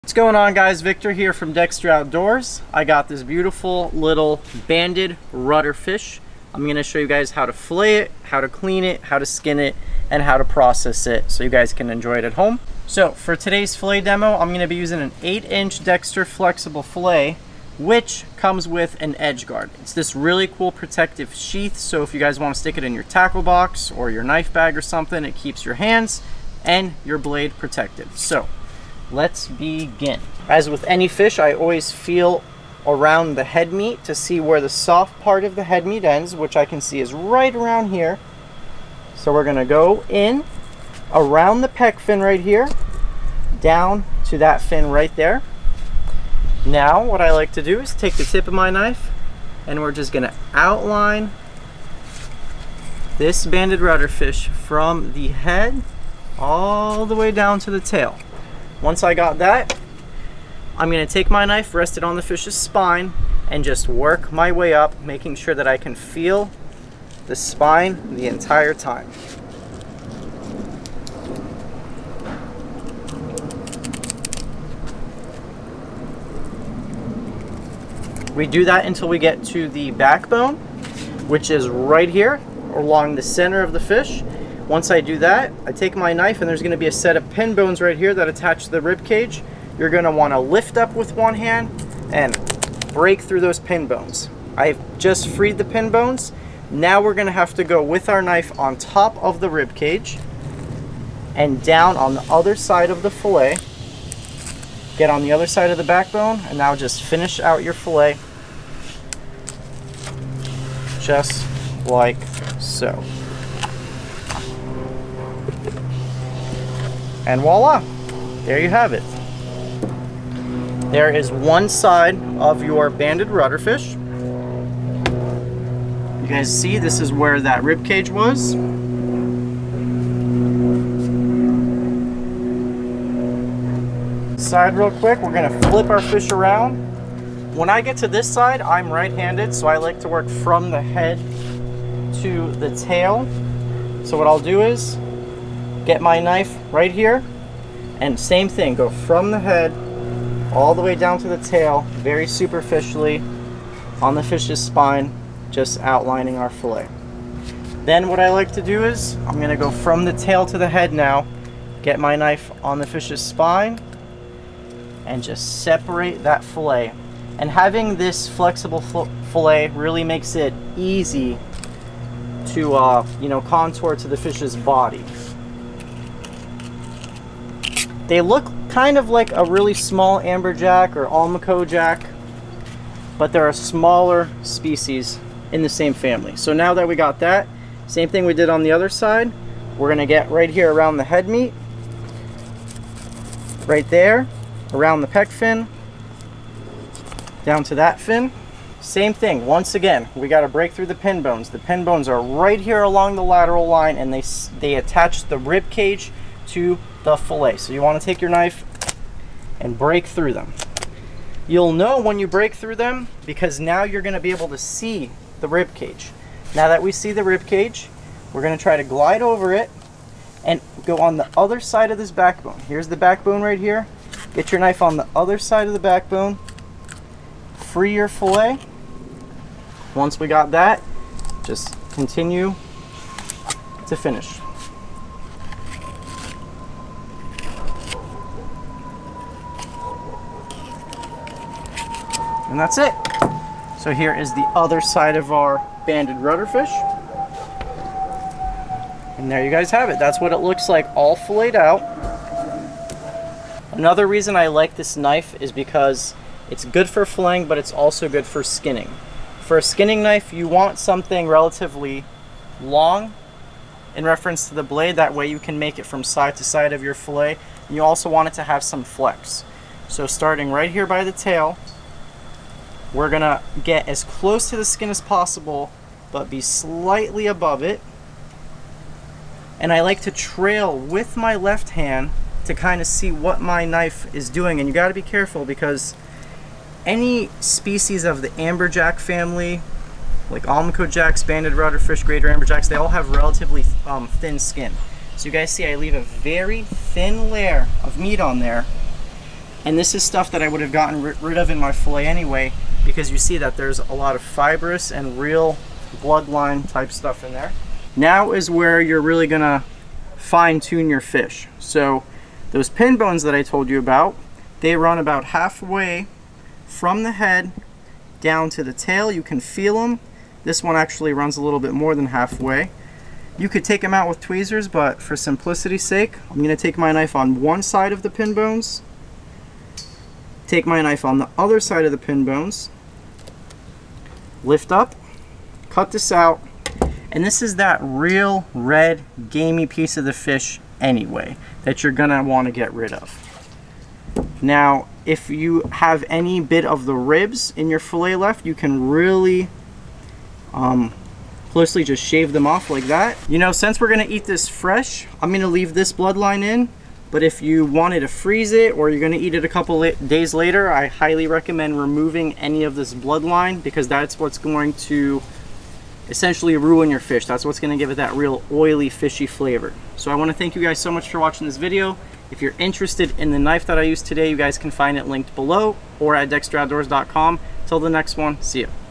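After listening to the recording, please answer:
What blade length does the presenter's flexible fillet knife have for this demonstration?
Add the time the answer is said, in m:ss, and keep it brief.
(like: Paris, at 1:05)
8 inch, at 0:15.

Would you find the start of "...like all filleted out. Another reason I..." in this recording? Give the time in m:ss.
4:10.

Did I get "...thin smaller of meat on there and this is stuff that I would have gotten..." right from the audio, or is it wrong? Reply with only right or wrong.
wrong.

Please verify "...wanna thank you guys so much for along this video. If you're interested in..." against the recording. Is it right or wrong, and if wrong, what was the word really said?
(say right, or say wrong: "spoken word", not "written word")
wrong: "watching", not "along".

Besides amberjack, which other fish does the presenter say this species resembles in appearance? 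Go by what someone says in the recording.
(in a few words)
almaco jack.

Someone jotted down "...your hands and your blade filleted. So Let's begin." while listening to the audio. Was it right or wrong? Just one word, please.
wrong.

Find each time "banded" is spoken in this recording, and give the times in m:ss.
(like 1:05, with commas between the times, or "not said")
0:04, 0:53, 2:02, 4:05, 4:51.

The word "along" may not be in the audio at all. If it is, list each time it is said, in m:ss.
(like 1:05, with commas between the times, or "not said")
1:22, 3:22.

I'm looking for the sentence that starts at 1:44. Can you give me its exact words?
Get on the other side of the backbone and now just finish out your fillet just like so.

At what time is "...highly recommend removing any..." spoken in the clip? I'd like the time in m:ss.
6:00.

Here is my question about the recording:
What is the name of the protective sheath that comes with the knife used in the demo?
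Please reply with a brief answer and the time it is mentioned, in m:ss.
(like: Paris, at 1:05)
edge guard, at 0:19.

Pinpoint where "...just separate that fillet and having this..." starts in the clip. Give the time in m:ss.
2:45.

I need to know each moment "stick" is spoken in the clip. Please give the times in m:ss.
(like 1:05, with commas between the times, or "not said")
0:22.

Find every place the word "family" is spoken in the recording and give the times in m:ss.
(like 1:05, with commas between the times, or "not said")
3:05, 4:48.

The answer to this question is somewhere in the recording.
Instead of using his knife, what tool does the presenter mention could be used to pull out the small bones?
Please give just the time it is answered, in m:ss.
5:24.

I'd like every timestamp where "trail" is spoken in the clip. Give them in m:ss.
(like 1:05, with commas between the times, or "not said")
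4:40.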